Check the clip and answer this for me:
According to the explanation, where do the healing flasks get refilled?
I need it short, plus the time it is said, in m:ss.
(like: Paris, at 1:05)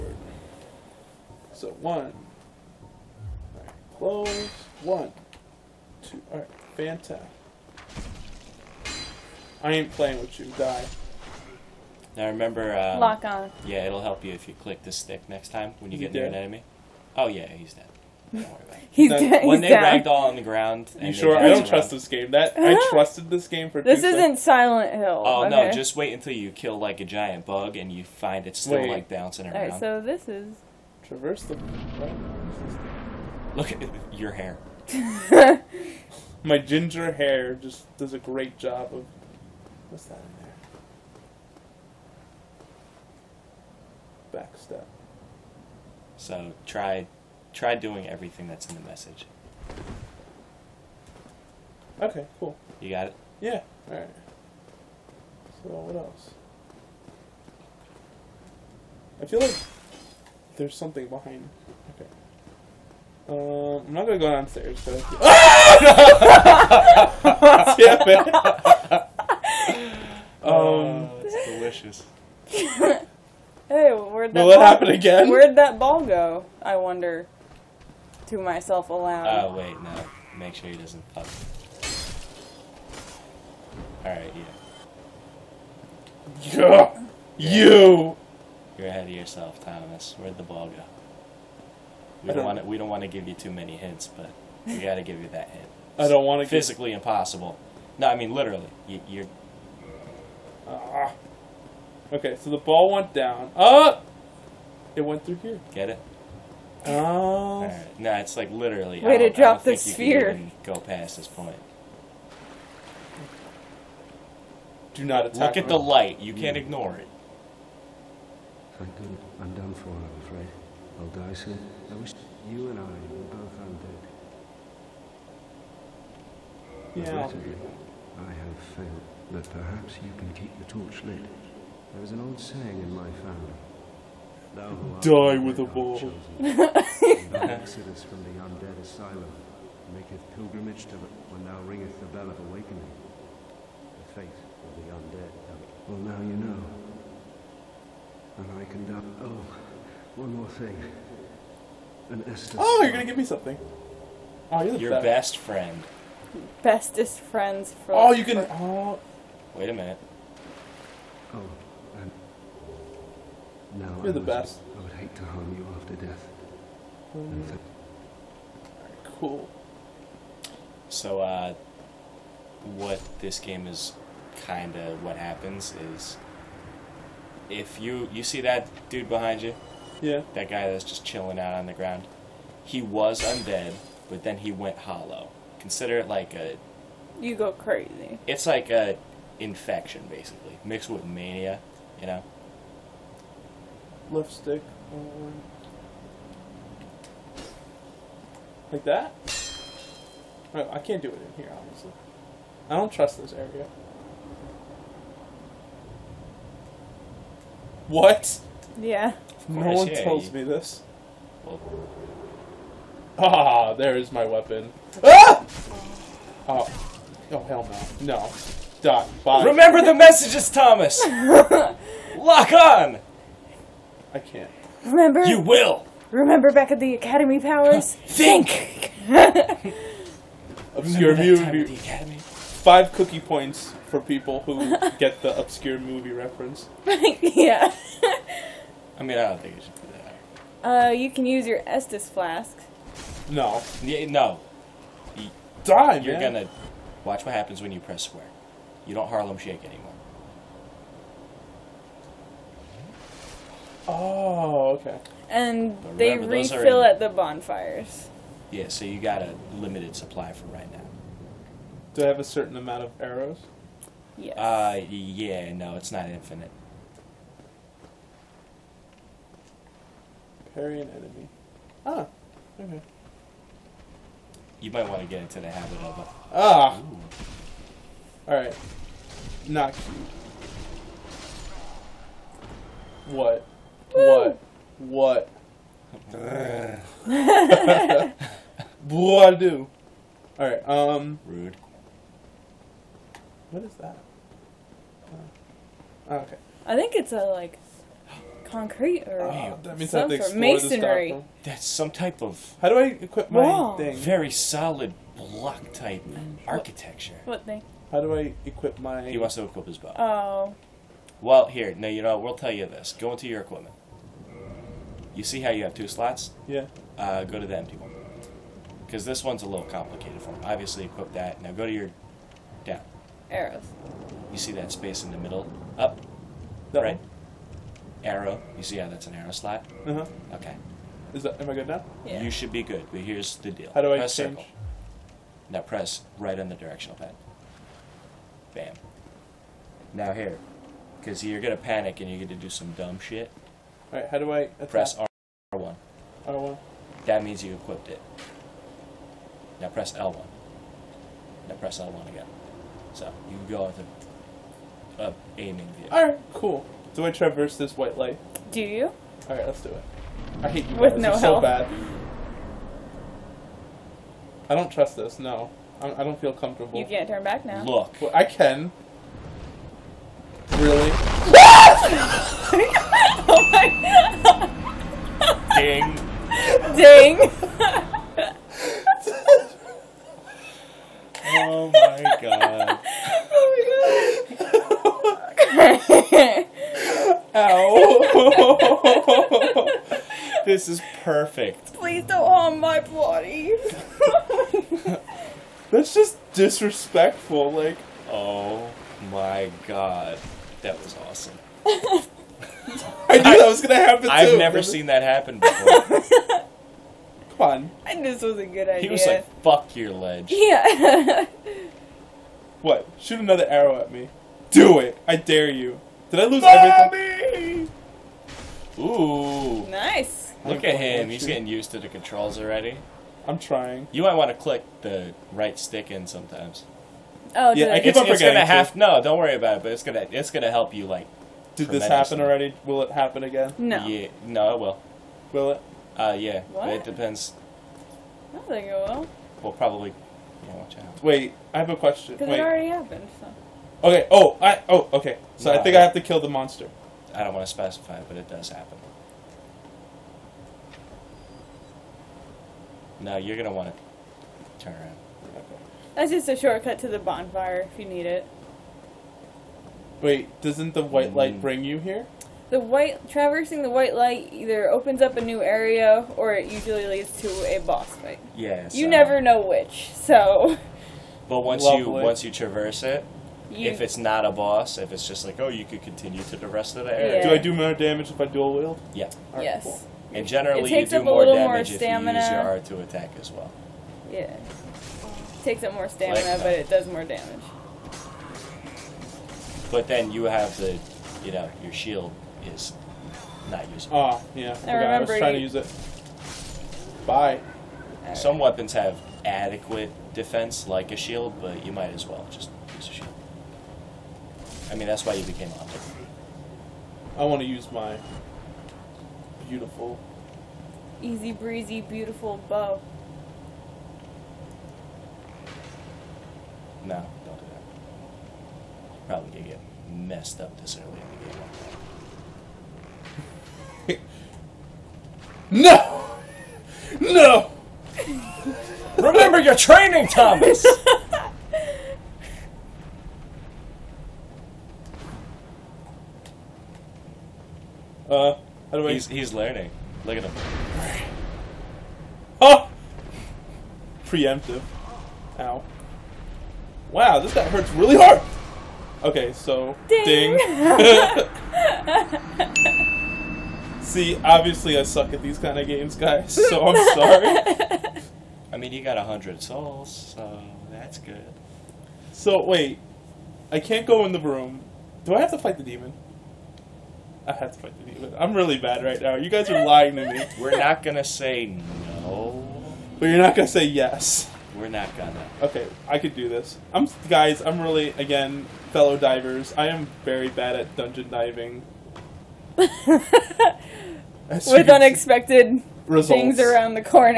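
at the bonfires, at 4:16.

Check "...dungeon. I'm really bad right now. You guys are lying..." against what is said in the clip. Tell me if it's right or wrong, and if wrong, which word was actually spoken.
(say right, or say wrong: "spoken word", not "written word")
wrong: "demon", not "dungeon".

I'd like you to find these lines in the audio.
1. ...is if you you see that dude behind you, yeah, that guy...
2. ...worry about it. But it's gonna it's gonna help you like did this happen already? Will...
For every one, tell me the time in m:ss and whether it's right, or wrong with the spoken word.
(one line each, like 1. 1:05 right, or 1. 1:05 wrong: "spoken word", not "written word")
1. 2:55 right
2. 7:09 right.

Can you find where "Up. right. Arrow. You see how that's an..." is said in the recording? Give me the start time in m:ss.
5:25.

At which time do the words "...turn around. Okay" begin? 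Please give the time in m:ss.
7:34.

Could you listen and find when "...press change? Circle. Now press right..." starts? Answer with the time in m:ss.
5:33.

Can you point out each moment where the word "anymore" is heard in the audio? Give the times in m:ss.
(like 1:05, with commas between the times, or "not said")
4:09.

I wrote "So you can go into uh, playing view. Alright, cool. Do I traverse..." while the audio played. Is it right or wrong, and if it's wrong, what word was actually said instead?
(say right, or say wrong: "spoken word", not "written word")
wrong: "aiming", not "playing".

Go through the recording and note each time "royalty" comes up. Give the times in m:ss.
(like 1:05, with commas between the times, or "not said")
not said.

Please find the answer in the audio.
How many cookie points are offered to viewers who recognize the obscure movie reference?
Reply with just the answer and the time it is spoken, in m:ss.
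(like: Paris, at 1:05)
5, at 3:51.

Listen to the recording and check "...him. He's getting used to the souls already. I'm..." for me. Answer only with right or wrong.
wrong.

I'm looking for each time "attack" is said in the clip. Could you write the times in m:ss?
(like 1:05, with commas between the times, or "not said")
1:55, 5:44, 8:02.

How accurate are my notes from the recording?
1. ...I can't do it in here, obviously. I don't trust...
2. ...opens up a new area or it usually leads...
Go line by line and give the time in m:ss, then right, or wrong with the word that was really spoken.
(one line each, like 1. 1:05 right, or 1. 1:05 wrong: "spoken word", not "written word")
1. 3:20 right
2. 7:44 right.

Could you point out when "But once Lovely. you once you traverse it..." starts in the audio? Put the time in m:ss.
7:51.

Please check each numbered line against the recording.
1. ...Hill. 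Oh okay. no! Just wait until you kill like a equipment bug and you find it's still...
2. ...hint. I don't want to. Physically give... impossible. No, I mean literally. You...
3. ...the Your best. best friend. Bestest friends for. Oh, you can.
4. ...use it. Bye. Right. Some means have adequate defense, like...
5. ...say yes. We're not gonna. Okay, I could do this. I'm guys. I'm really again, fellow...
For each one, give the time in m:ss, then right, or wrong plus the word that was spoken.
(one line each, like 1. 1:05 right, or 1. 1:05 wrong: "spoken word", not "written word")
1. 0:24 wrong: "giant", not "equipment"
2. 1:35 right
3. 2:34 right
4. 8:15 wrong: "weapons", not "means"
5. 9:33 right.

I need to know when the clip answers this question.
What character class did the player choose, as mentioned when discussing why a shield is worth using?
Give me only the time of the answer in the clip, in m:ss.
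8:25.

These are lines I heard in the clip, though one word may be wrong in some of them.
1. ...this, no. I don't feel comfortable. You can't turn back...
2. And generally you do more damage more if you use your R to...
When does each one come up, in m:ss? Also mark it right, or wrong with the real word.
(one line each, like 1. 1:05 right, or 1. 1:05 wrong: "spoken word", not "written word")
1. 6:04 right
2. 8:00 right.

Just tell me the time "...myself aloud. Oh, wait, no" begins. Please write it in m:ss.
1:18.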